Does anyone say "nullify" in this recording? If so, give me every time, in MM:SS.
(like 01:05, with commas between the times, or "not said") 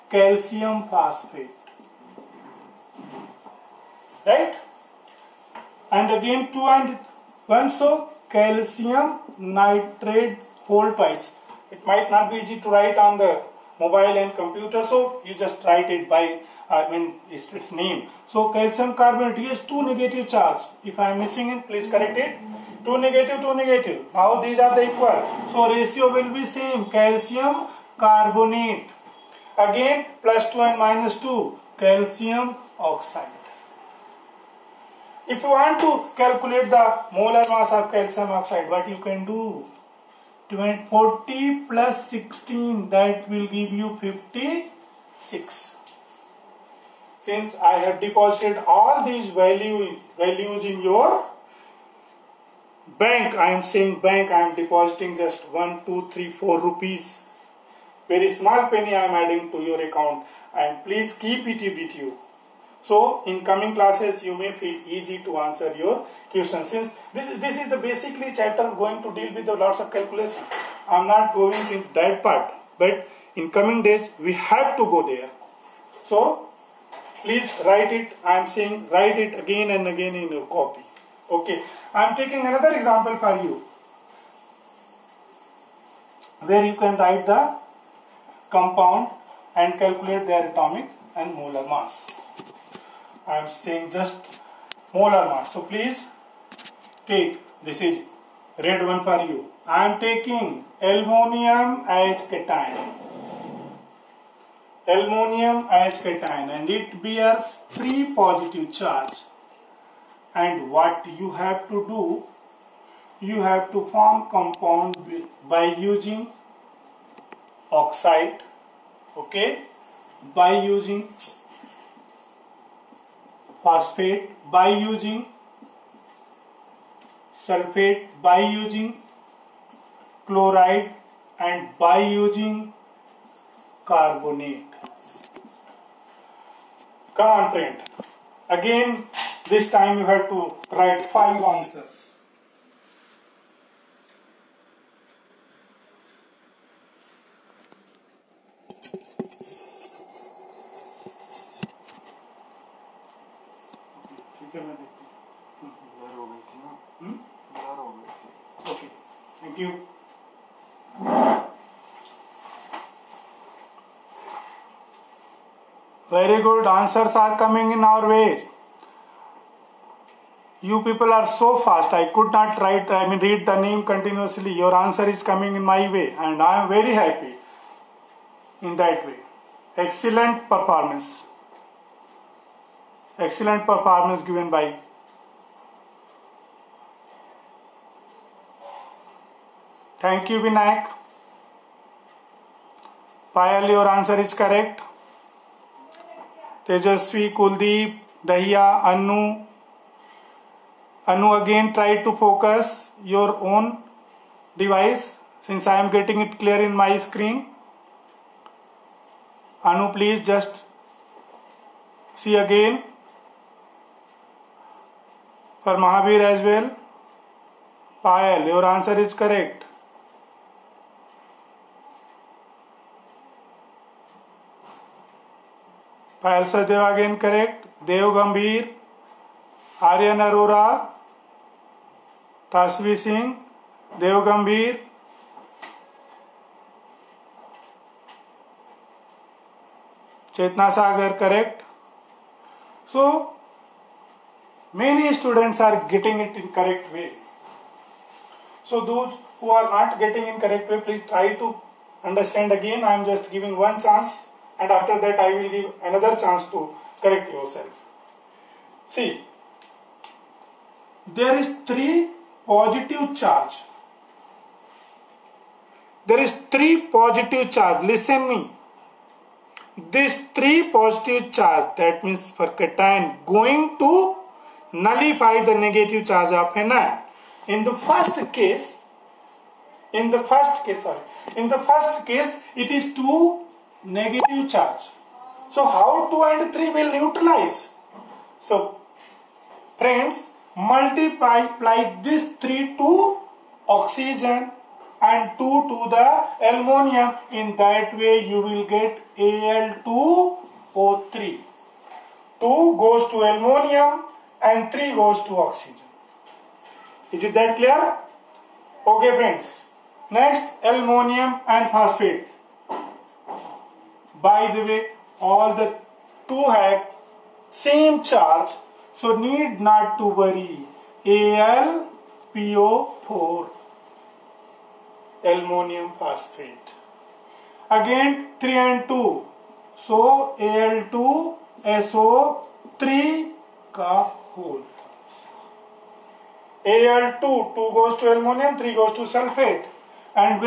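04:34.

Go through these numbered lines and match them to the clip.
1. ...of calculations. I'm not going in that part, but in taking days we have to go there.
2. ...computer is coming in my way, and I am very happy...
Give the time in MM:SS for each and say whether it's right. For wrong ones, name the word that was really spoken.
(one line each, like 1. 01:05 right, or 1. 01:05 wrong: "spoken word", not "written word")
1. 01:09 wrong: "coming", not "taking"
2. 02:54 wrong: "answer", not "computer".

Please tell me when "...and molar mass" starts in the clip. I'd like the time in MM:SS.
01:31.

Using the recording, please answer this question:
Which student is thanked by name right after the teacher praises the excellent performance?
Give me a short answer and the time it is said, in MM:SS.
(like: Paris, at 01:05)
Vinayak, at 03:10.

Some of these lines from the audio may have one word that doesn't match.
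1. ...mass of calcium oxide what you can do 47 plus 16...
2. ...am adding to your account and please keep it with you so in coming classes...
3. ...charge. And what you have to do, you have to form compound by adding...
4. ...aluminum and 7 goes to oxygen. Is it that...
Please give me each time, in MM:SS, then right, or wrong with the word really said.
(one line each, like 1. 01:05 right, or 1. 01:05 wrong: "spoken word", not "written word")
1. 00:37 wrong: "40", not "47"
2. 00:59 right
3. 01:48 wrong: "using", not "adding"
4. 05:03 wrong: "3", not "7".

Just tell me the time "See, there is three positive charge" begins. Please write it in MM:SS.
04:18.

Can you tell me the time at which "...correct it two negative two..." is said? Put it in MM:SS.
00:21.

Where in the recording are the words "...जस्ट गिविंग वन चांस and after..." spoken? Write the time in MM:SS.
04:13.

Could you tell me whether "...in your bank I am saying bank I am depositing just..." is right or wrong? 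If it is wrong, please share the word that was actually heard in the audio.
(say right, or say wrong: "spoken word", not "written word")
right.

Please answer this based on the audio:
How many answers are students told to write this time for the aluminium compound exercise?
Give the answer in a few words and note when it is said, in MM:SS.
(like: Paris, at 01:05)
5, at 02:21.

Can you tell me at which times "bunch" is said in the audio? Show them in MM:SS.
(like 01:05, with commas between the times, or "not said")
not said.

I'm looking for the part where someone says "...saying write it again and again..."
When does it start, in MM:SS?
01:18.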